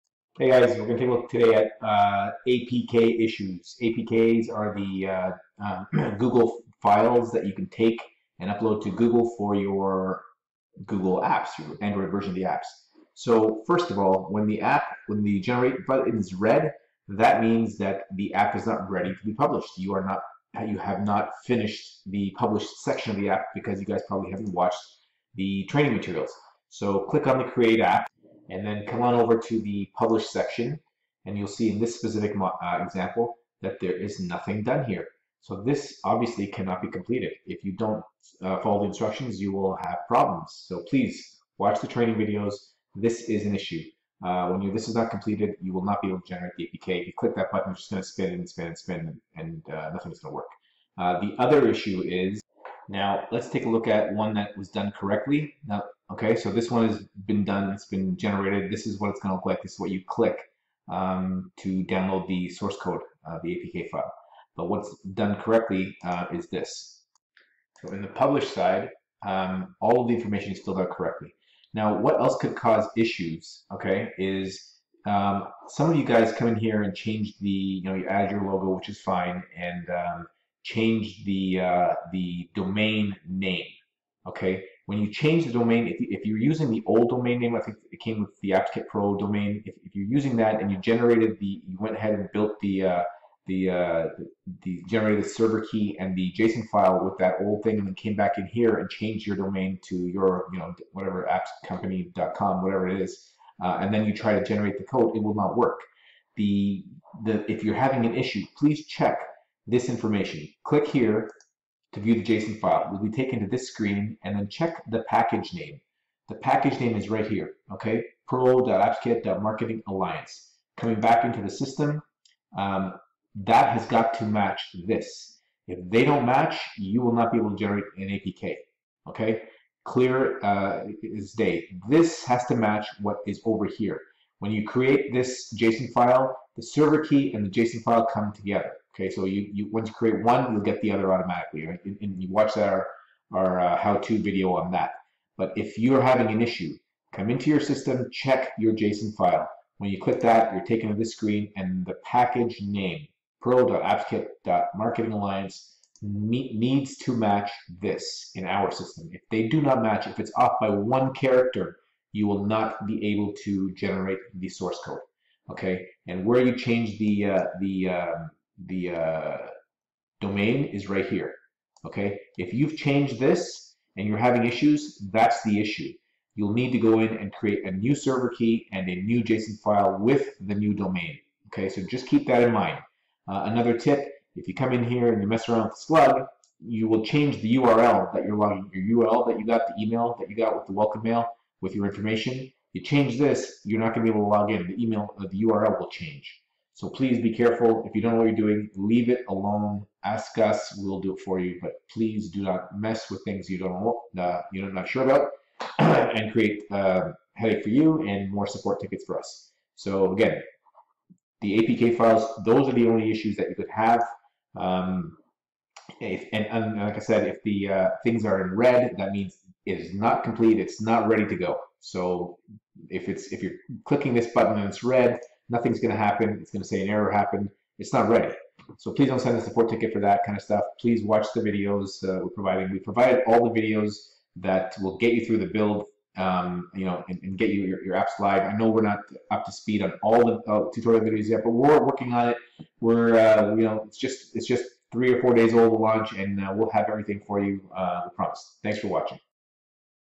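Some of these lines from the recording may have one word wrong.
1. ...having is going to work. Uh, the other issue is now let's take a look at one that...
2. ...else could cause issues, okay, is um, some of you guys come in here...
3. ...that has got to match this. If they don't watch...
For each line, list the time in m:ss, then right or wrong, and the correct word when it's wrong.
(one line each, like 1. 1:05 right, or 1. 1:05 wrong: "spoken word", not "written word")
1. 0:49 wrong: "nothing", not "having"
2. 1:12 right
3. 2:03 wrong: "match", not "watch".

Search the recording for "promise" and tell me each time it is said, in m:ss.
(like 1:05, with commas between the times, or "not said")
4:08.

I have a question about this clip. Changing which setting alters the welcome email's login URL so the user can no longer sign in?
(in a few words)
Slug.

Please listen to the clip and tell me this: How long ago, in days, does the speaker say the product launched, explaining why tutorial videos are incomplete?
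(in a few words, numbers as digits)
3 or 4 days.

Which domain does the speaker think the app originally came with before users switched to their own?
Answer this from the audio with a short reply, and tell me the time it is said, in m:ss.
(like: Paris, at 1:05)
AppsKit Pro domain, at 1:28.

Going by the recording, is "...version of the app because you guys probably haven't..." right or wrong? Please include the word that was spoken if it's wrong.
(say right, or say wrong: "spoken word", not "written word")
wrong: "section", not "version".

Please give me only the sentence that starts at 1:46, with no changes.
The the if you're having an issue, please check this information.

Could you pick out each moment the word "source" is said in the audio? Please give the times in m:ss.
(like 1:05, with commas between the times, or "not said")
1:02, 2:44.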